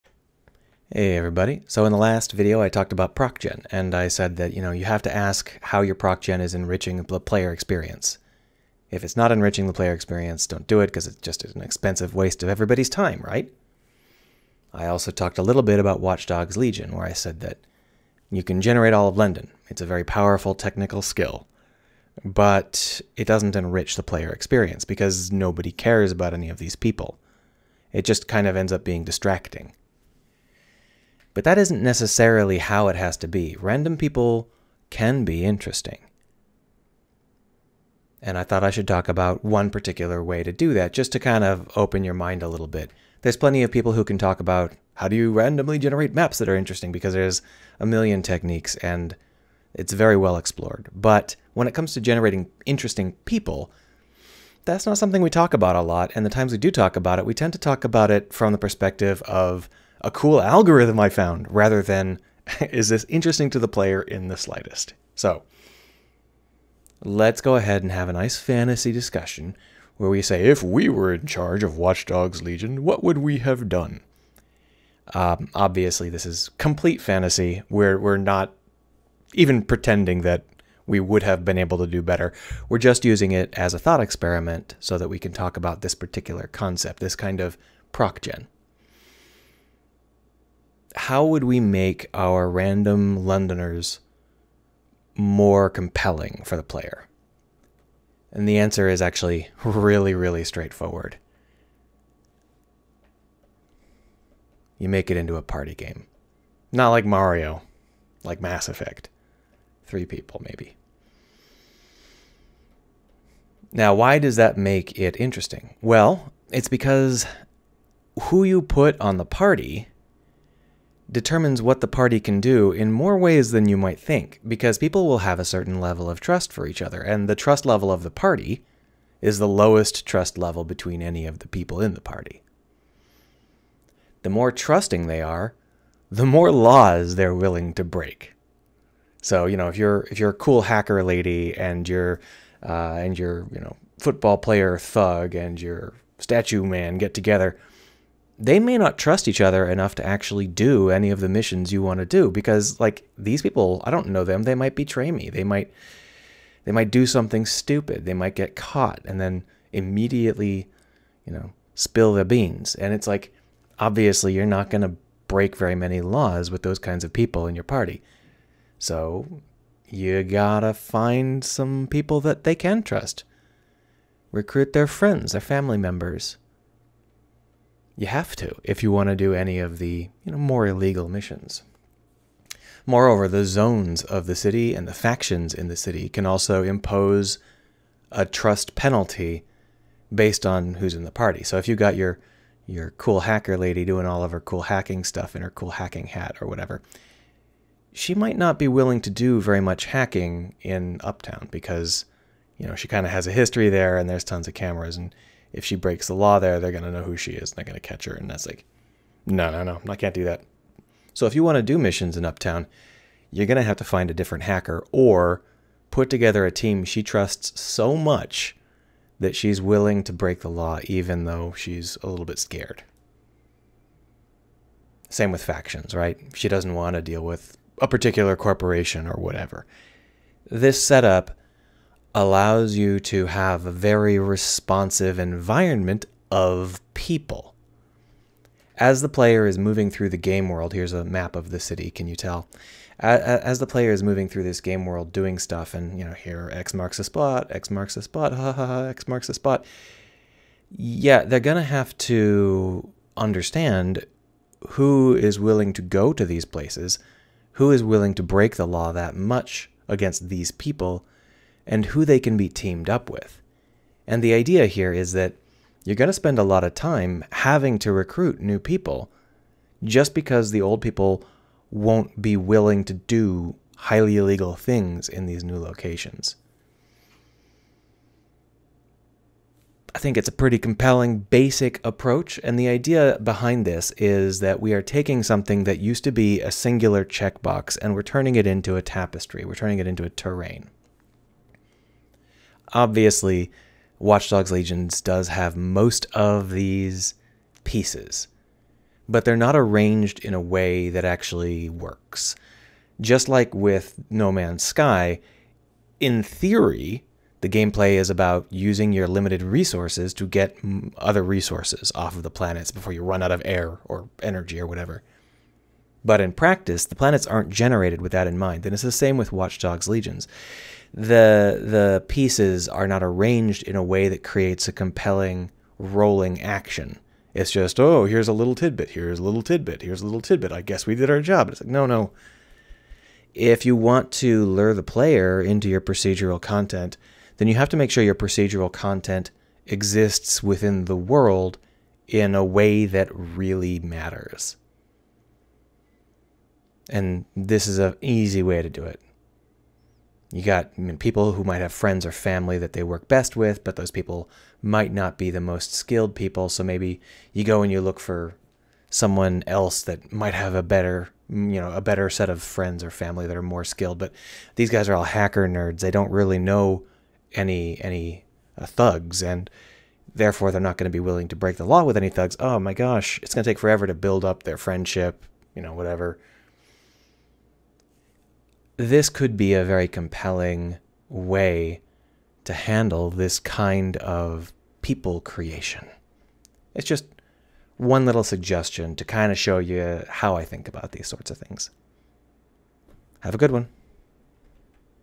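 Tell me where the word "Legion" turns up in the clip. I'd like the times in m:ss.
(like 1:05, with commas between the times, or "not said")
0:16, 1:12, 4:54, 5:19.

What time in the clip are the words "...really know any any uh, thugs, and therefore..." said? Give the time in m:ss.
6:06.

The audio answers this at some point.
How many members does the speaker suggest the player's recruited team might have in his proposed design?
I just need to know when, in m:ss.
1:49.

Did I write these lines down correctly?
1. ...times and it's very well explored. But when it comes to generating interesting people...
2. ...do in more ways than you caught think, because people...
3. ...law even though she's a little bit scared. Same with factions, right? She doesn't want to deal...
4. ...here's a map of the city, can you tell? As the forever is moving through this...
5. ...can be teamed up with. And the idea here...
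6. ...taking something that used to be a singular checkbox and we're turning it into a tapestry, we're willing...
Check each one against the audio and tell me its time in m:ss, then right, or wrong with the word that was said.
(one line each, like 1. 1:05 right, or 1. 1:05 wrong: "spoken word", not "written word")
1. 0:48 wrong: "techniques", not "times"
2. 2:02 wrong: "might", not "caught"
3. 3:40 right
4. 4:00 wrong: "player", not "forever"
5. 4:22 right
6. 4:44 wrong: "turning", not "willing".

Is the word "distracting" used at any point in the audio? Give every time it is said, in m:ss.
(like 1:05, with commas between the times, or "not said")
0:29.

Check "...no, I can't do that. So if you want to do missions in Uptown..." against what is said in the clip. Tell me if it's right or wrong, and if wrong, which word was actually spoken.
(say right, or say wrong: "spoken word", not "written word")
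right.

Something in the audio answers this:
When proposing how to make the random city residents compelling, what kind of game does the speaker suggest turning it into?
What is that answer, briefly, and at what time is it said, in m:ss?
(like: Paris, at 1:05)
A party game, at 1:45.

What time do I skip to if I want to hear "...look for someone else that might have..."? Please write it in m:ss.
5:57.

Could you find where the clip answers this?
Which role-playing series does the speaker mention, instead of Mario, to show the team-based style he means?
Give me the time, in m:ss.
1:48.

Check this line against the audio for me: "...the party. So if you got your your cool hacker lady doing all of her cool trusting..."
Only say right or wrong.
wrong.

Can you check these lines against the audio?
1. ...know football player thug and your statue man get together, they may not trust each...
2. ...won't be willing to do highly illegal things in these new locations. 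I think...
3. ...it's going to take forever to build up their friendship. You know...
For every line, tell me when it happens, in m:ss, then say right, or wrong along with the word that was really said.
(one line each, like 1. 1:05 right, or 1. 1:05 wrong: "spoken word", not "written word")
1. 2:23 right
2. 4:31 right
3. 6:13 right.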